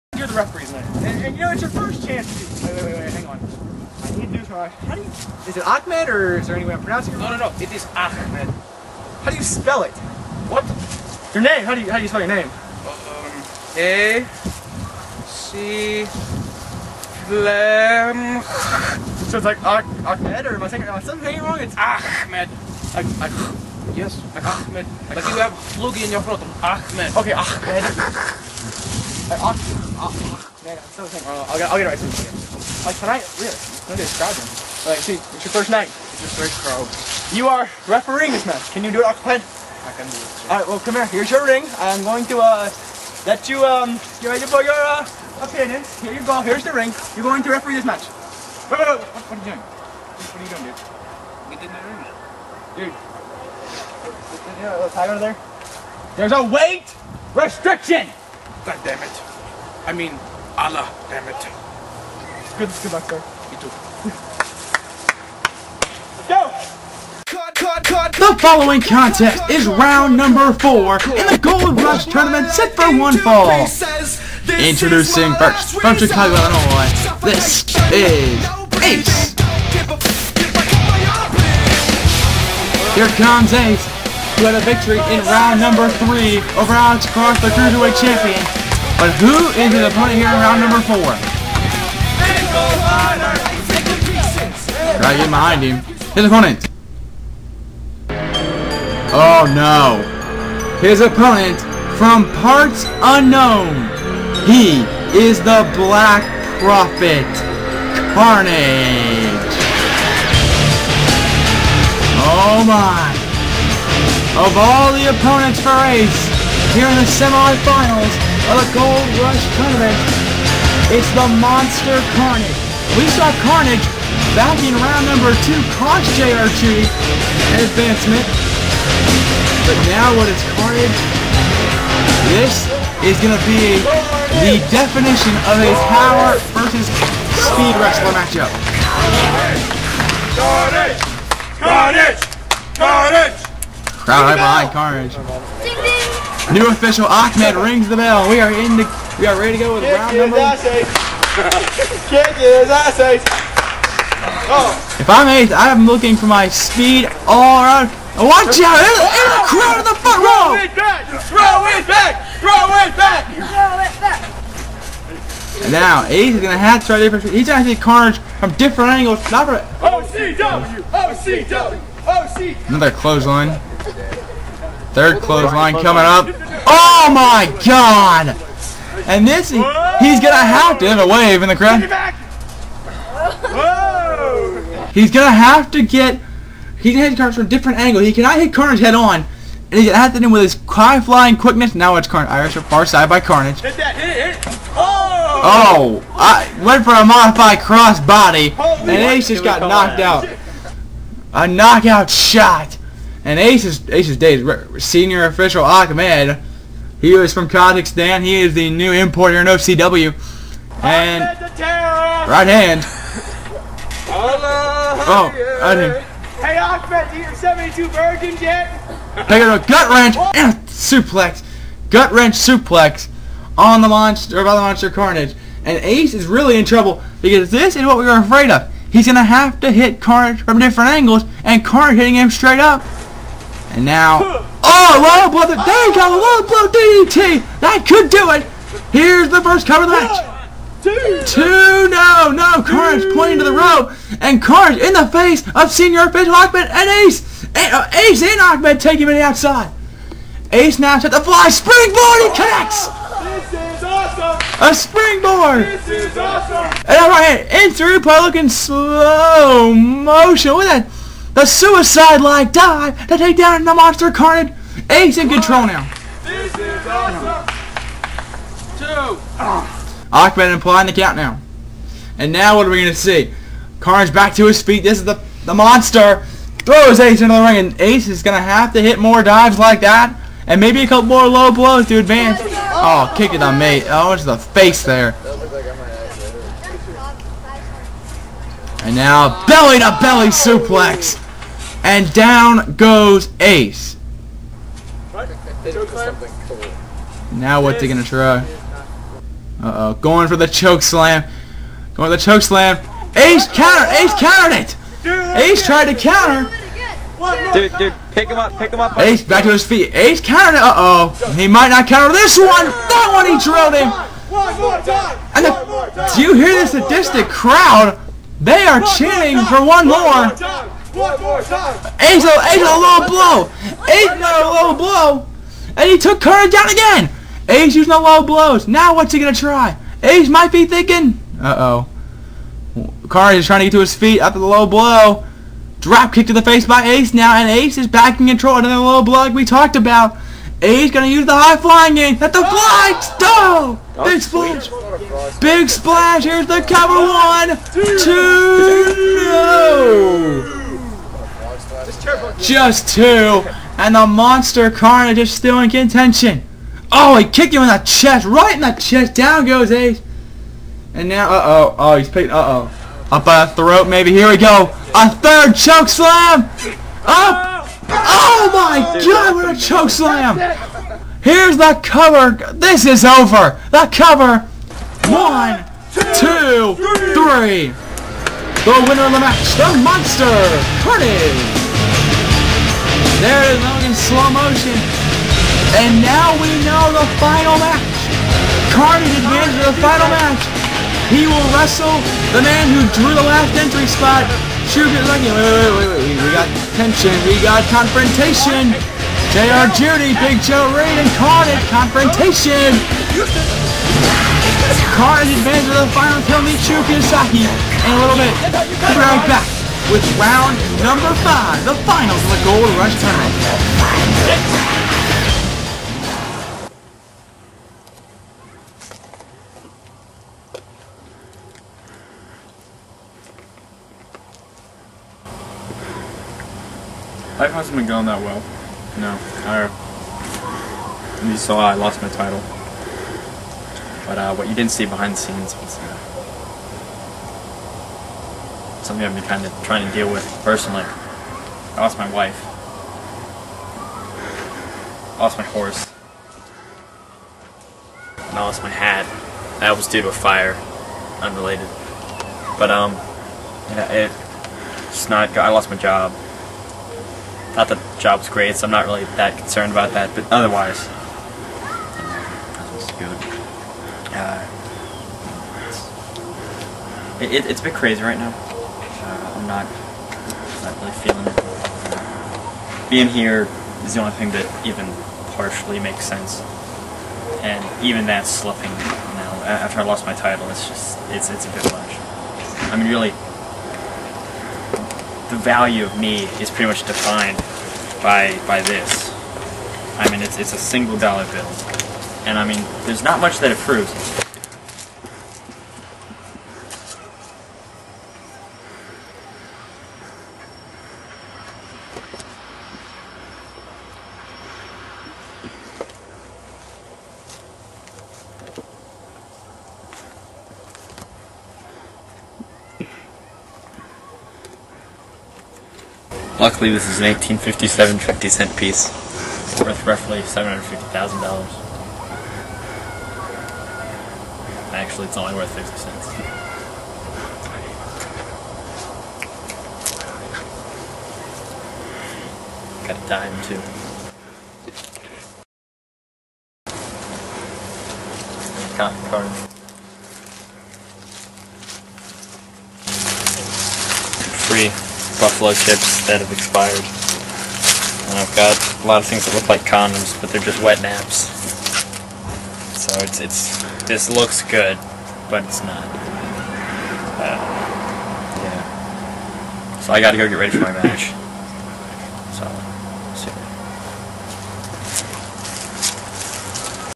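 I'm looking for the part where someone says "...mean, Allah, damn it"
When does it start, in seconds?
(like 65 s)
59 s.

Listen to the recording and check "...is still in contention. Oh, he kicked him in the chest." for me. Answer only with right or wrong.
right.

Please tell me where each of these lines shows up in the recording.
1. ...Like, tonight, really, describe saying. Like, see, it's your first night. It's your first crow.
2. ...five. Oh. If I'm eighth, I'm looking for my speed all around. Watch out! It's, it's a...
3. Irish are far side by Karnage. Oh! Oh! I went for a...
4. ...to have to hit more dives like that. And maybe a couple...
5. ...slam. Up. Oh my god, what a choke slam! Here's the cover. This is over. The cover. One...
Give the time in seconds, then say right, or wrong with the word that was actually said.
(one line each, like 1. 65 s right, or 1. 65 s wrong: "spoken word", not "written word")
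1. 32 s wrong: "describing", not "saying"
2. 152 s wrong: "eight", not "five"
3. 192 s right
4. 278 s right
5. 365 s right.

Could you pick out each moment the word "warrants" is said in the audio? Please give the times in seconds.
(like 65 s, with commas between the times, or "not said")
not said.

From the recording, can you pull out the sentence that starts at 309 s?
Ace countered Uh oh, he might not counter this one.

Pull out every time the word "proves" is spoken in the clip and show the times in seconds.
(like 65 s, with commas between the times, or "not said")
493 s.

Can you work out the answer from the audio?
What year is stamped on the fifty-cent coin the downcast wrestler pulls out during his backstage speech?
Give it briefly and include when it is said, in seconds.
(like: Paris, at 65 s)
1857, at 517 s.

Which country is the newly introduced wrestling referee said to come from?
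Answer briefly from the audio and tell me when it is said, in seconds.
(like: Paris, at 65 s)
Kazakhstan, at 207 s.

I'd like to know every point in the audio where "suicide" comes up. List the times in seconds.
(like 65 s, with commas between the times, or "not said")
261 s.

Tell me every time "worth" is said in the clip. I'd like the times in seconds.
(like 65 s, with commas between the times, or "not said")
519 s, 525 s.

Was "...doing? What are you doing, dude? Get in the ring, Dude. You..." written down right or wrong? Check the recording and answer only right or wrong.
right.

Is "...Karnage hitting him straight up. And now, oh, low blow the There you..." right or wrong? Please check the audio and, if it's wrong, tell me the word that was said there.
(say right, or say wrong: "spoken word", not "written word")
right.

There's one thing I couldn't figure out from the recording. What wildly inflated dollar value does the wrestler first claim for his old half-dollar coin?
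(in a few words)
$750,000.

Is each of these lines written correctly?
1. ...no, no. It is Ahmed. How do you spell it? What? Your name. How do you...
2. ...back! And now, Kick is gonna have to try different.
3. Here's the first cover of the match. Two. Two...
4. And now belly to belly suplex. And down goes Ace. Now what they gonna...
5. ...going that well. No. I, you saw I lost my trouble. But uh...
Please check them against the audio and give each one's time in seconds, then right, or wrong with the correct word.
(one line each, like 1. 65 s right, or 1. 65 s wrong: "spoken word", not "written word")
1. 7 s right
2. 164 s wrong: "Ace", not "Kick"
3. 238 s right
4. 288 s right
5. 427 s wrong: "title", not "trouble".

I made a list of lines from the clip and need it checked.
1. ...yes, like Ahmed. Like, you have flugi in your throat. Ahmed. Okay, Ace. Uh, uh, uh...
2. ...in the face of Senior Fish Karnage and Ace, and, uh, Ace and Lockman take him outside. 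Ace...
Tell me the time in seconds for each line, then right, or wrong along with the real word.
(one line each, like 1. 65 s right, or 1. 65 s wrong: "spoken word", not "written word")
1. 23 s wrong: "Ahmed", not "Ace"
2. 244 s wrong: "Lockman", not "Karnage".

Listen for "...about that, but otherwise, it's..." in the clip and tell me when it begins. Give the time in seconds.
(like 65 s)
459 s.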